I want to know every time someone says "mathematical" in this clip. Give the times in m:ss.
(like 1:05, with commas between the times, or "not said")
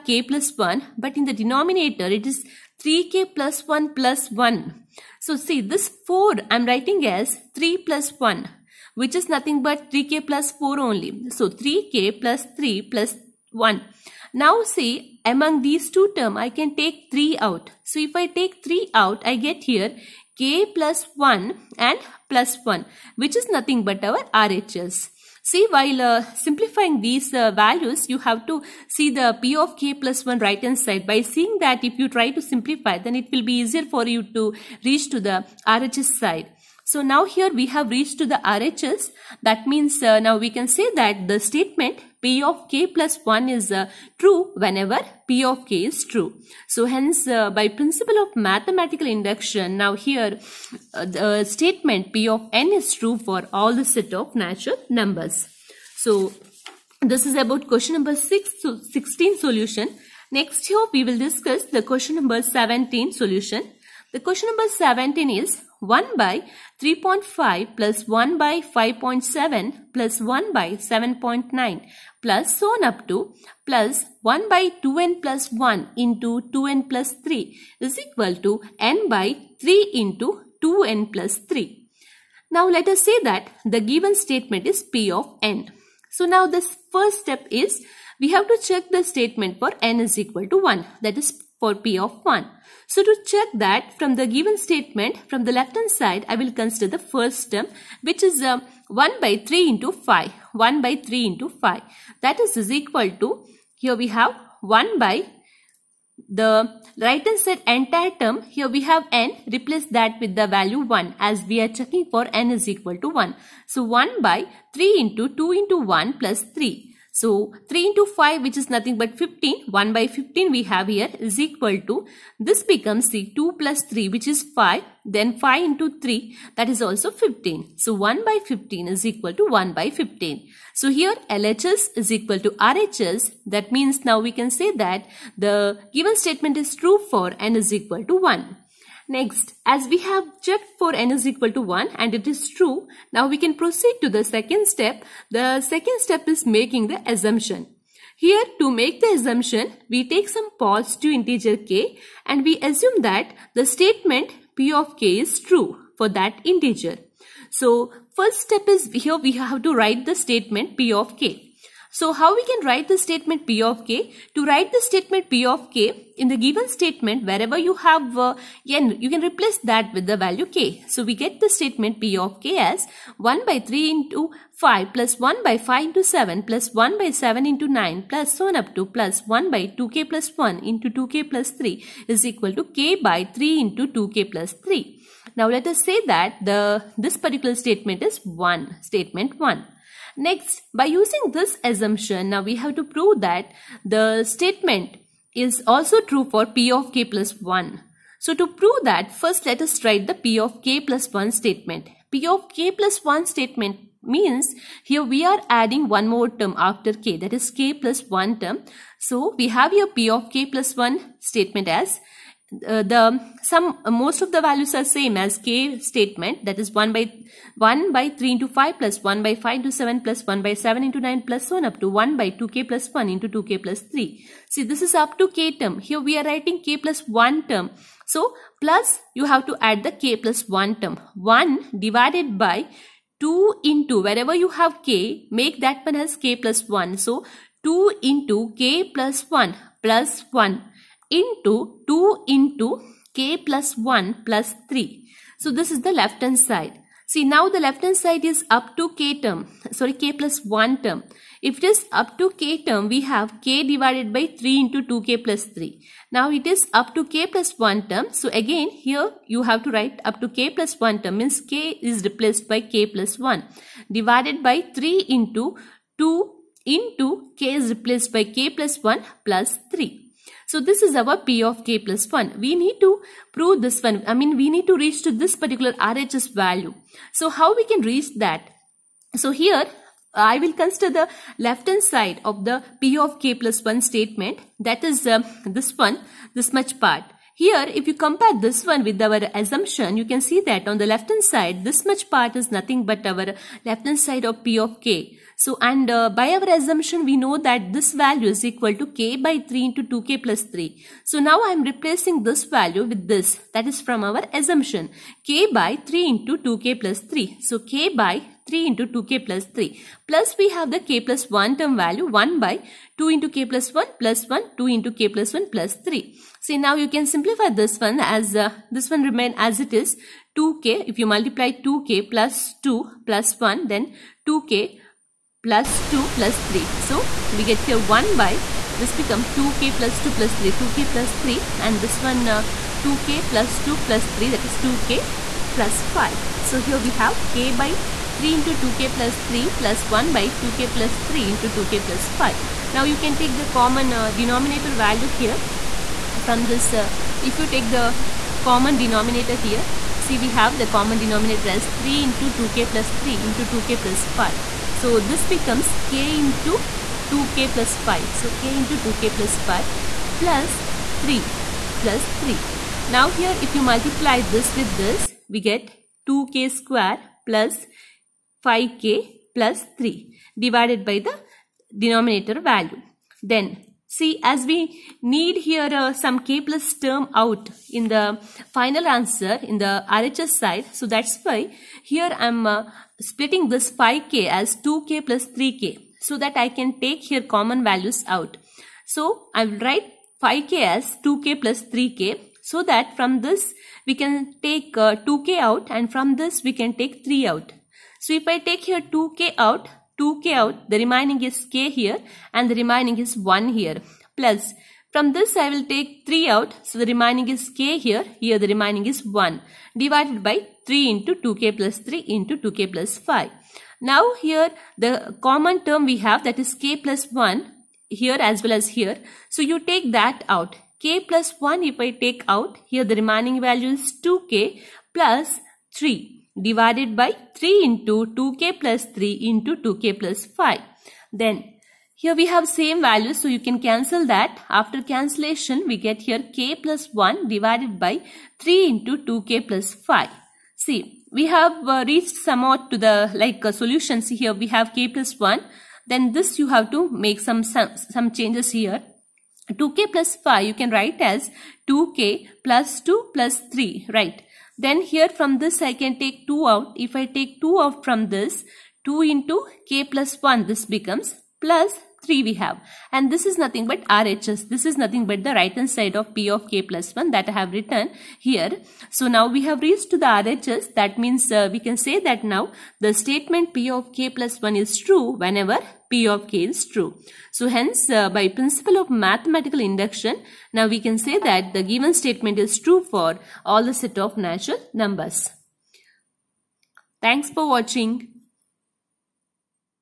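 0:48, 7:58.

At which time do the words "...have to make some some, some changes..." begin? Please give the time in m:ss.
7:26.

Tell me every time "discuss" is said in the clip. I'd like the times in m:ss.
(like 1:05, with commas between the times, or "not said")
1:01.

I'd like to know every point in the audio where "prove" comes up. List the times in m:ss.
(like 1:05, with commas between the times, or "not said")
3:12, 3:18, 4:33.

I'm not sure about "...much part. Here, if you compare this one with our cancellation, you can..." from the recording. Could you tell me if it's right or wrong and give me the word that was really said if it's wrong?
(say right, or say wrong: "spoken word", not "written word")
wrong: "assumption", not "cancellation".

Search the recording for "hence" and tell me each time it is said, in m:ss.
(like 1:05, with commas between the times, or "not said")
0:46, 7:57.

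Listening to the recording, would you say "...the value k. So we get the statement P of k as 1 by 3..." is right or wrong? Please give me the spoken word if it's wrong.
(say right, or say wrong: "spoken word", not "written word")
right.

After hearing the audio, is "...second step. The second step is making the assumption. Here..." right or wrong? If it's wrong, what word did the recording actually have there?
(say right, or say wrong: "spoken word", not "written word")
right.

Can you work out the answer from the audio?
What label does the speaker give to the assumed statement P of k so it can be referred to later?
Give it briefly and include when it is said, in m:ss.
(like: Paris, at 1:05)
statement 1, at 3:08.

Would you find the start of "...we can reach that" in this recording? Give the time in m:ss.
4:37.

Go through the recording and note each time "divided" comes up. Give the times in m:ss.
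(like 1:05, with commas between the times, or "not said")
3:51, 4:13, 4:23, 6:10, 6:49, 7:06, 7:17.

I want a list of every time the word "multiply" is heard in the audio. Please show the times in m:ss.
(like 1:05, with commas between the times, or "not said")
5:21, 6:03.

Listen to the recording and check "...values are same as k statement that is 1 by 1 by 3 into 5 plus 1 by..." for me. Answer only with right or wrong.
right.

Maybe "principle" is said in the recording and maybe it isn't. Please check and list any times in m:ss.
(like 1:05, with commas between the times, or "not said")
0:47, 7:58.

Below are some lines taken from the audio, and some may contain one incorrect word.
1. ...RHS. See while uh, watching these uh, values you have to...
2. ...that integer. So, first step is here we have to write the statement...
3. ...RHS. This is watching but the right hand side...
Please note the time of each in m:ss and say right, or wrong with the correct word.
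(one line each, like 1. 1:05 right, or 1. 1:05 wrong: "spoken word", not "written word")
1. 0:24 wrong: "simplifying", not "watching"
2. 2:36 right
3. 7:43 wrong: "nothing", not "watching".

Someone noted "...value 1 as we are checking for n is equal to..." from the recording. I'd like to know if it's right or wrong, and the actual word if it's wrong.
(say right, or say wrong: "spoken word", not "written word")
right.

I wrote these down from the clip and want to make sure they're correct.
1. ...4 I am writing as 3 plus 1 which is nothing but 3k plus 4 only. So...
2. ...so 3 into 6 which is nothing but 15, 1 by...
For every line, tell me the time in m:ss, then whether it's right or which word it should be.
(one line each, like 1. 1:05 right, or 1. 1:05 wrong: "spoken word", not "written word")
1. 0:06 right
2. 1:57 wrong: "5", not "6".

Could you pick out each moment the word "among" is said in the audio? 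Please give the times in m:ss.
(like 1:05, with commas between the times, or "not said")
0:15.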